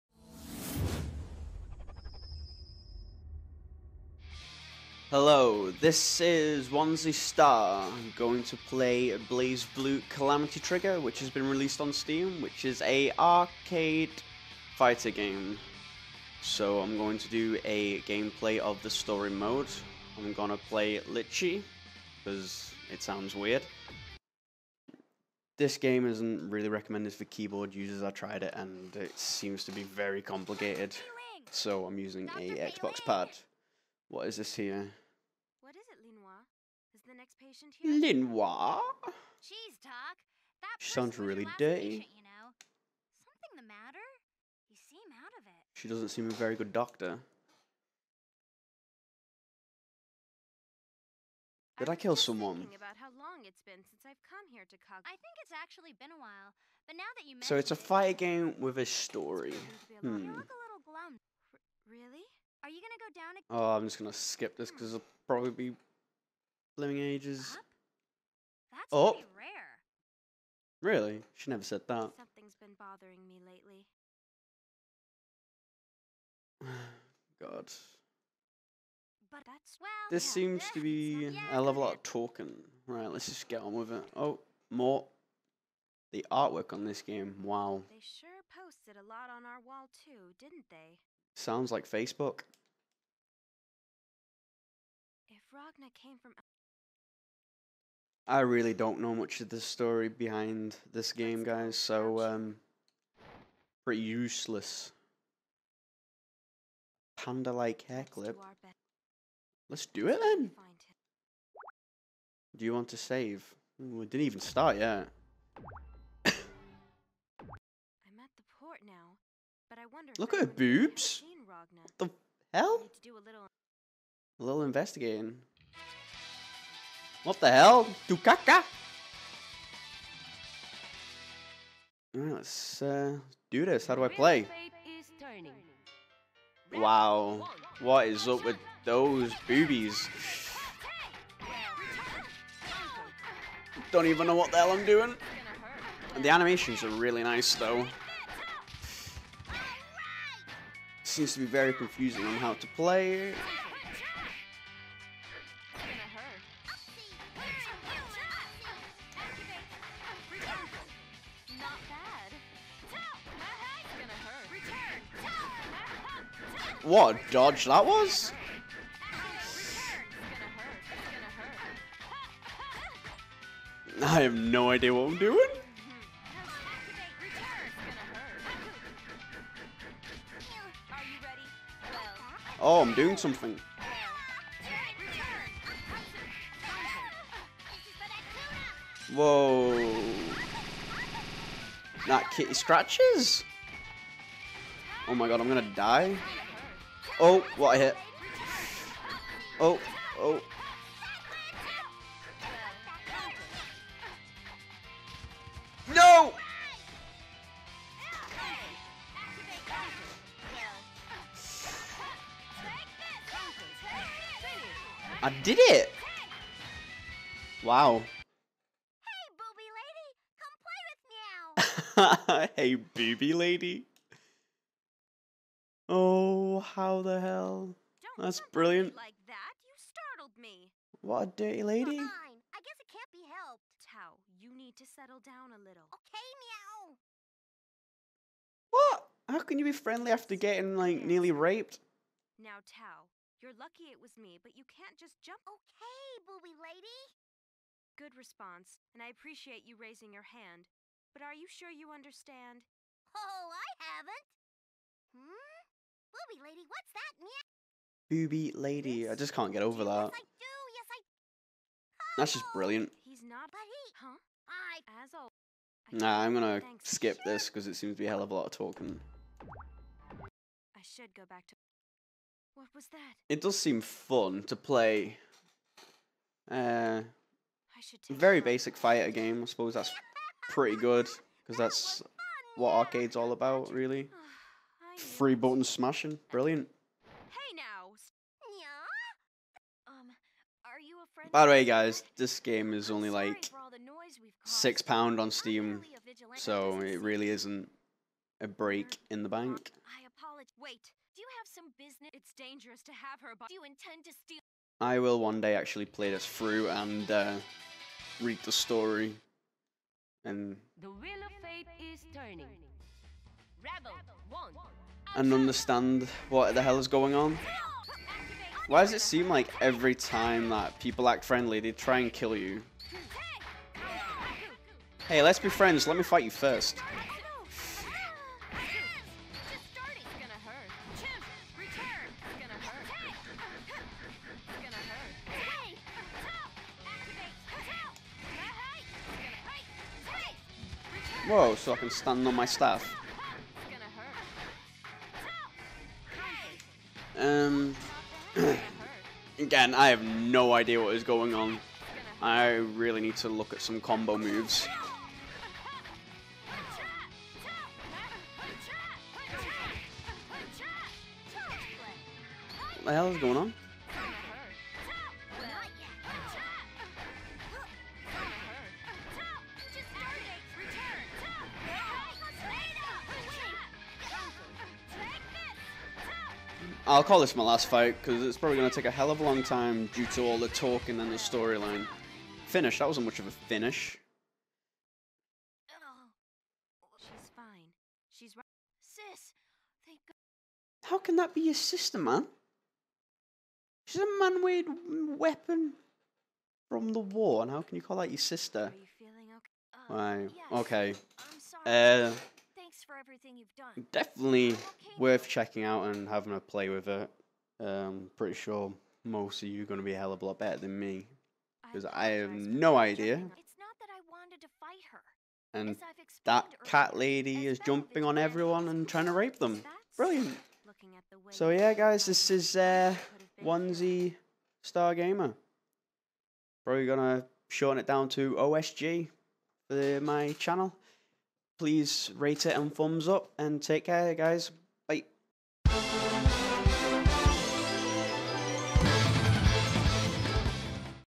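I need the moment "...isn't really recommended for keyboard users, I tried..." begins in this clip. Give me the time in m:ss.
0:26.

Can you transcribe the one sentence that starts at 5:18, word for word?
Why does it seem like every time that people act friendly, they try and kill you?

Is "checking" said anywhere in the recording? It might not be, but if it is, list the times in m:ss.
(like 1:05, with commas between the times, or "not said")
6:45.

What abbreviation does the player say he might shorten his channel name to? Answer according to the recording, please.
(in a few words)
OSG.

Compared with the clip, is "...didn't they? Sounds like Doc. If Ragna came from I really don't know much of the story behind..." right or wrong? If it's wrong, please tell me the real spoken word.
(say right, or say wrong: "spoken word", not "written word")
wrong: "Facebook", not "Doc".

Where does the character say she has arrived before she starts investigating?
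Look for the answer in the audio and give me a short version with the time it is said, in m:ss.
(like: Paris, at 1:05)
The port, at 1:58.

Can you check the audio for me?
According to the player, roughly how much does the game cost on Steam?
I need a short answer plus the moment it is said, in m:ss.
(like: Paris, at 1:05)
6 pounds, at 4:54.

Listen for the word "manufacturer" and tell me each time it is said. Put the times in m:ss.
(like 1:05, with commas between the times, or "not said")
not said.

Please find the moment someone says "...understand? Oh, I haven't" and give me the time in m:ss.
4:11.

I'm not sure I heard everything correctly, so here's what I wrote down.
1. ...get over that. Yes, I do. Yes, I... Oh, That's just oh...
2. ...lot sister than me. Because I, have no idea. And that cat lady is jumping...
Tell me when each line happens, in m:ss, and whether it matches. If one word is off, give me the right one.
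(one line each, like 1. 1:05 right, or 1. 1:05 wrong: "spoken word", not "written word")
1. 4:19 right
2. 6:50 wrong: "better", not "sister".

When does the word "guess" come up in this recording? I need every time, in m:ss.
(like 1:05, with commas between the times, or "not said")
3:52.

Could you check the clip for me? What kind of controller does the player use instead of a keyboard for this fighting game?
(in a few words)
Xbox pad.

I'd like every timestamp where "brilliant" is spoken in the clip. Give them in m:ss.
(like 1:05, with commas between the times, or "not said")
3:48, 4:22, 4:46, 6:59.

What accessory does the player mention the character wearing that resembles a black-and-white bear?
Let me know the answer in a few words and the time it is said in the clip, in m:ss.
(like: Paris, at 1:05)
Panda-like hair clip, at 1:47.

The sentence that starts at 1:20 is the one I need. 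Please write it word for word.
This yeah, seems to be a level of talking.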